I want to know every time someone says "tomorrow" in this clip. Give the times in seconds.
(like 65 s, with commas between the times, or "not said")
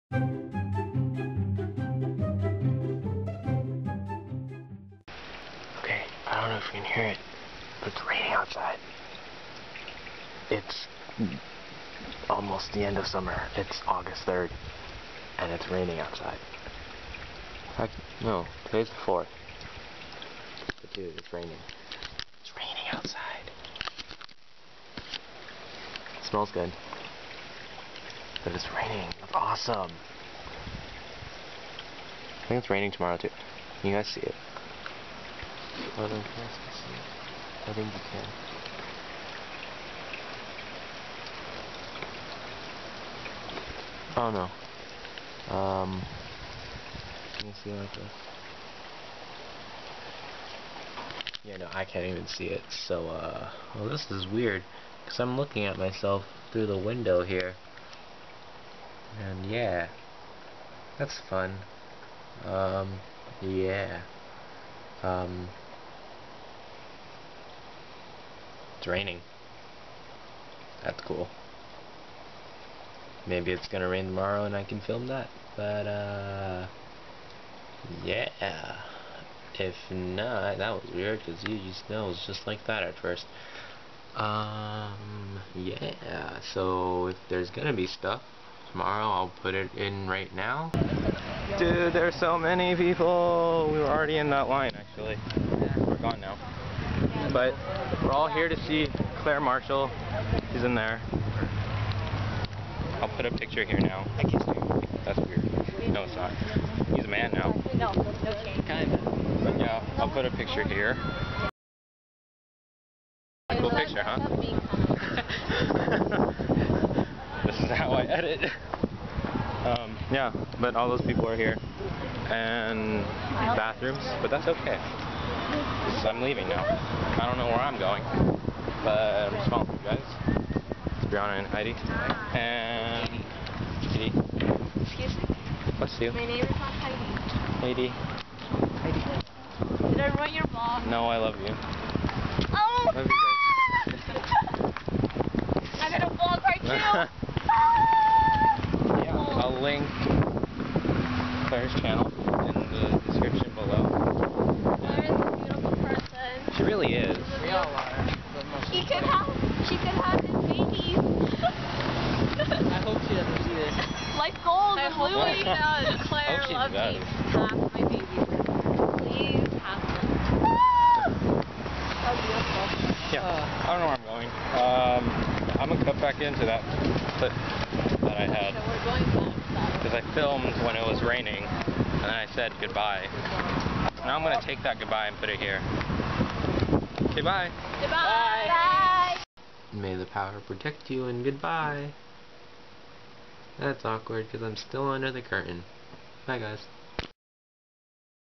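32 s, 74 s, 88 s.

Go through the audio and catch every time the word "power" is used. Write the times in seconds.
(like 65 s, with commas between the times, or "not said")
190 s.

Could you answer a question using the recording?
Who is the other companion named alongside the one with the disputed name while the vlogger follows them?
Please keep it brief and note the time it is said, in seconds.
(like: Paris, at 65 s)
Brianna, at 131 s.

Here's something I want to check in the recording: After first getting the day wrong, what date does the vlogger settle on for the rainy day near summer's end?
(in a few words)
August 4.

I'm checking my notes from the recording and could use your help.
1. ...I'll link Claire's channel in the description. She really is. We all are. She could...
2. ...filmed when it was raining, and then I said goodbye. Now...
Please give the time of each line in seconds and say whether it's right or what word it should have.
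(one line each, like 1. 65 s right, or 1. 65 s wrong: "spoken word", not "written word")
1. 149 s right
2. 180 s right.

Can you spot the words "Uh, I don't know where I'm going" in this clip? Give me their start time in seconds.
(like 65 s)
173 s.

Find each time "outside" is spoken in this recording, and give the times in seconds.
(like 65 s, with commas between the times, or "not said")
8 s, 15 s, 22 s.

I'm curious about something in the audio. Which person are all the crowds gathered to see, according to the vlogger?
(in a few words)
Claire Marshall.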